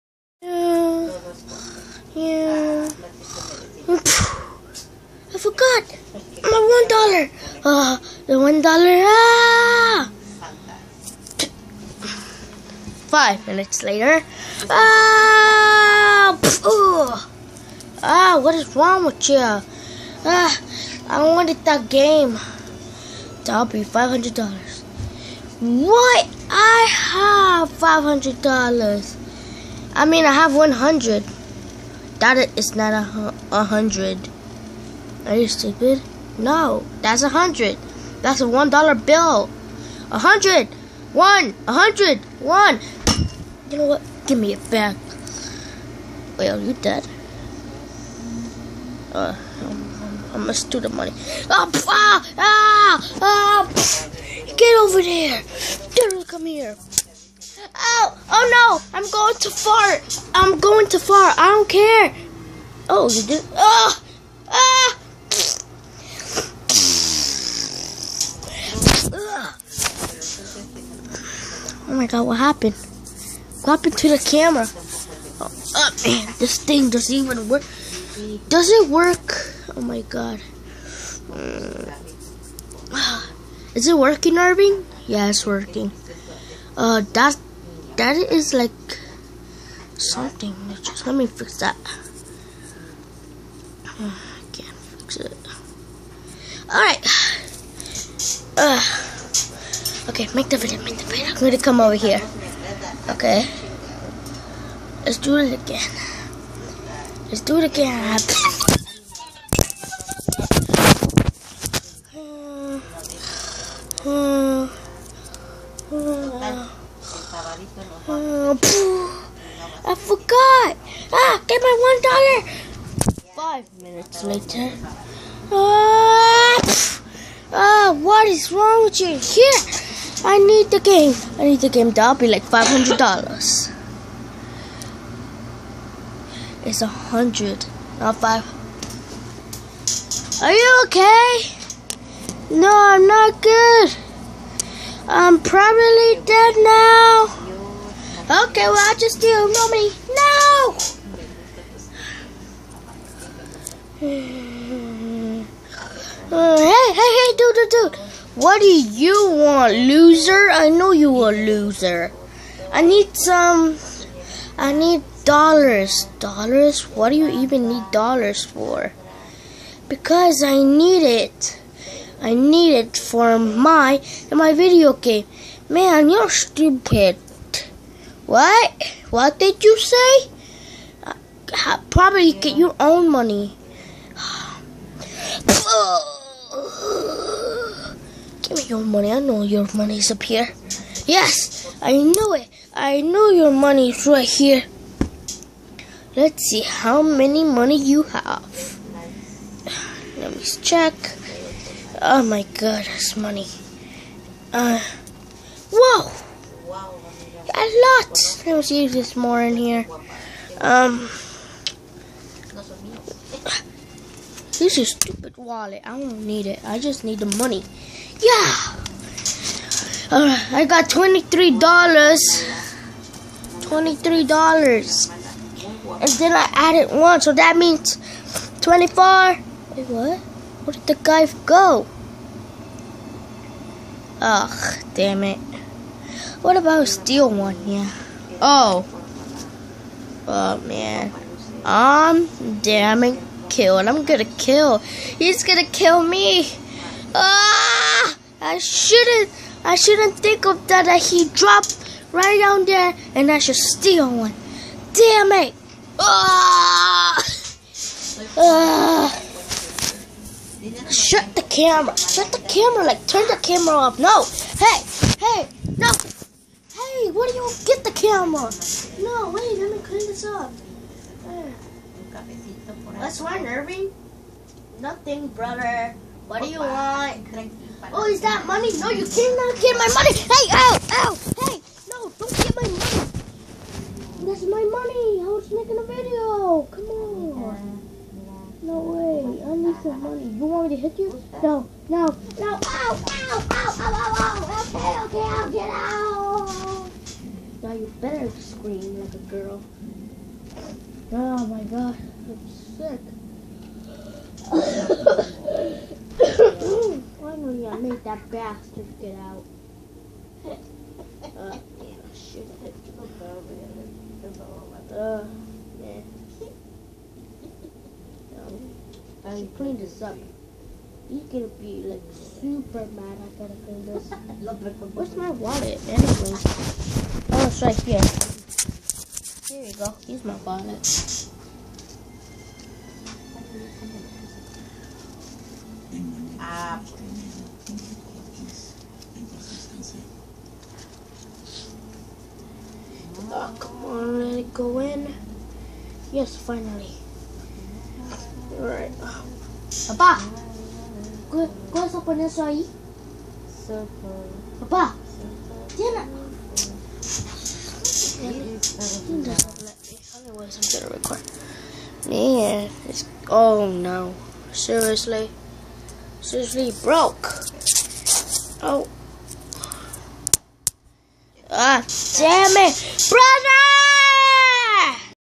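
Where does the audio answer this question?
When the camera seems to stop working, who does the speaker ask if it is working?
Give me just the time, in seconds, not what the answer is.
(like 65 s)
84 s.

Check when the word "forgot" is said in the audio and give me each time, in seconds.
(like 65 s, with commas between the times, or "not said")
5 s, 119 s.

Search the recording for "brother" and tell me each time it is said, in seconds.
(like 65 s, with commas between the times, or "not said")
275 s, 373 s.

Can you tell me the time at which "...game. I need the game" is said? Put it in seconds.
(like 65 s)
130 s.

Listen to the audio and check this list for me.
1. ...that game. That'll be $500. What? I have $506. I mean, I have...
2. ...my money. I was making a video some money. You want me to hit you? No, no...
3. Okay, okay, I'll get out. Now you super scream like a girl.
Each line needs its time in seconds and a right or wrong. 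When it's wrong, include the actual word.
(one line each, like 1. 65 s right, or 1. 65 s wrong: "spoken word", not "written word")
1. 21 s wrong: "500", not "506"
2. 284 s right
3. 295 s wrong: "better", not "super".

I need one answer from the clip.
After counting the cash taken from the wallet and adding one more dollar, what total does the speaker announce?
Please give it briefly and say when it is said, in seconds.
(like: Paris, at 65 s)
24, at 228 s.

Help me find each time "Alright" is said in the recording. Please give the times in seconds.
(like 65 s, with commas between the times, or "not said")
96 s, 220 s, 348 s.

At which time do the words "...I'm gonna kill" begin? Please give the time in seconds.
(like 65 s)
243 s.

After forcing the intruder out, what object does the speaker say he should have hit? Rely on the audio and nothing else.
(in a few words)
the bell.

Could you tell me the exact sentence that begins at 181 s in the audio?
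Uh, probably get your own money.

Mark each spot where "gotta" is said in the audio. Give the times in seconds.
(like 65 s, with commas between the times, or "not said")
323 s.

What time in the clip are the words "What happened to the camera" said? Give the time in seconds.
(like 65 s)
73 s.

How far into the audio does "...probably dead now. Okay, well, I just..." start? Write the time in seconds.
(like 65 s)
145 s.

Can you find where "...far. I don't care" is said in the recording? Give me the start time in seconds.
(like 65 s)
60 s.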